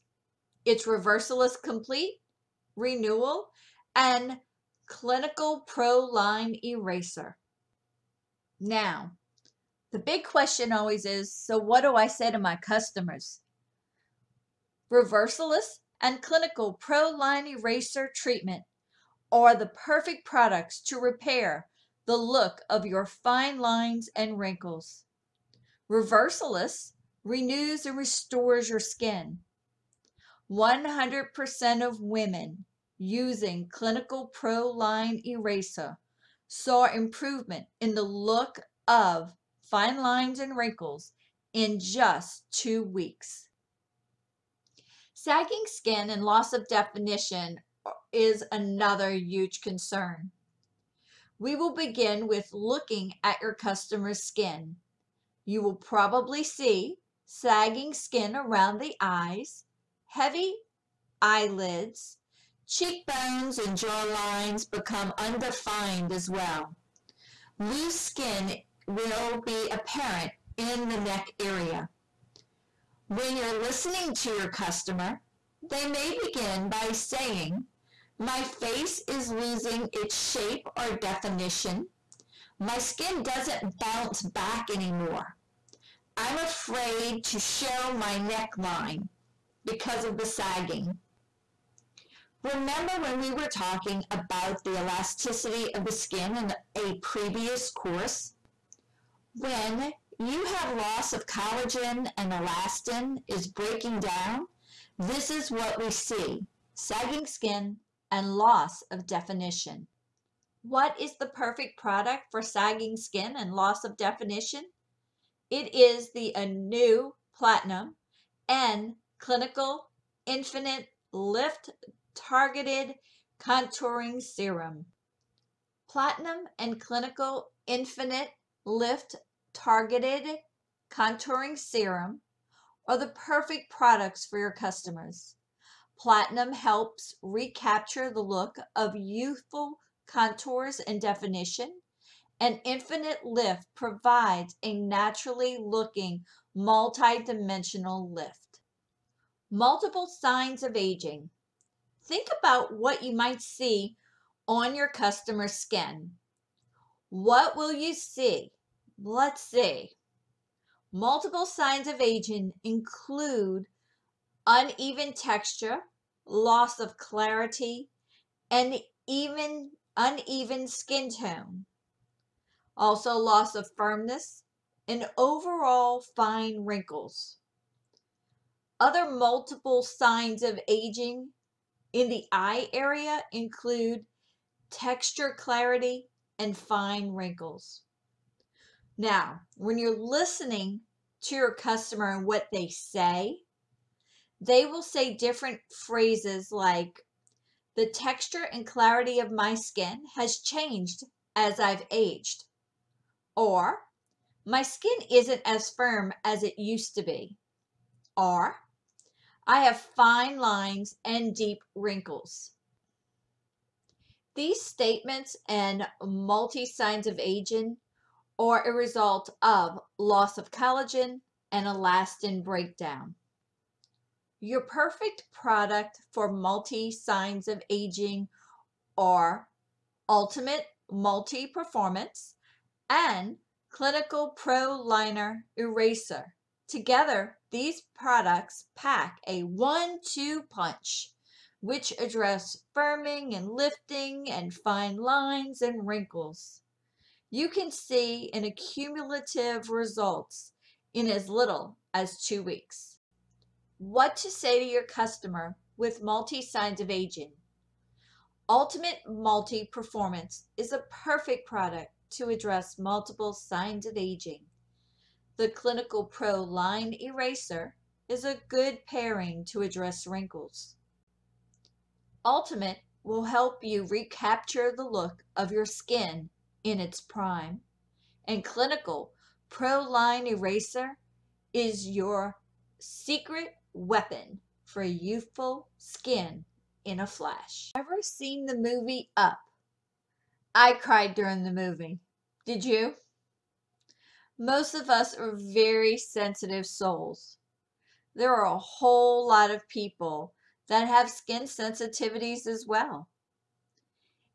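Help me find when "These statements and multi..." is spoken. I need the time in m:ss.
3:34.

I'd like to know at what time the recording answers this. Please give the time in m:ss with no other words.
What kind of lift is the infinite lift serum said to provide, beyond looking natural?
2:26.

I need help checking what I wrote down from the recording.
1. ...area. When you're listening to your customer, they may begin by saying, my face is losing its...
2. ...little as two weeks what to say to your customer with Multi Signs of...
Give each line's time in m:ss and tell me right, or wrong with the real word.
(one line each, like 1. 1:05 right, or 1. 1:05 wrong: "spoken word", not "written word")
1. 1:11 right
2. 4:11 right.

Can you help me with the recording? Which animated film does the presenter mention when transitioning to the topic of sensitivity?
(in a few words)
Up.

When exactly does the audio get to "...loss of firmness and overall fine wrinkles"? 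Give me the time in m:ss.
2:53.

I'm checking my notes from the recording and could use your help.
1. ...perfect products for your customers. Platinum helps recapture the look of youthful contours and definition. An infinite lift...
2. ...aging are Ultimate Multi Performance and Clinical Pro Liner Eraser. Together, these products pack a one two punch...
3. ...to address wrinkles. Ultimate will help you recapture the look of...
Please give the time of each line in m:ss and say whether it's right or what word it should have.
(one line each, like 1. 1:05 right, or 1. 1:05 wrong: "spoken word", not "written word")
1. 2:13 right
2. 3:47 right
3. 4:29 right.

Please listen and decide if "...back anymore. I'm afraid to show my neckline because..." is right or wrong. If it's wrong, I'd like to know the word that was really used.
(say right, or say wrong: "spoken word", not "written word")
right.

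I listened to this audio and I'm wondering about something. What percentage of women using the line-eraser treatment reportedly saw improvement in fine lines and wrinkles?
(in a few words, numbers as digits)
100%.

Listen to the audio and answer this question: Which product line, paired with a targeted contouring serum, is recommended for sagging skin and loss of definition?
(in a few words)
Anew Platinum.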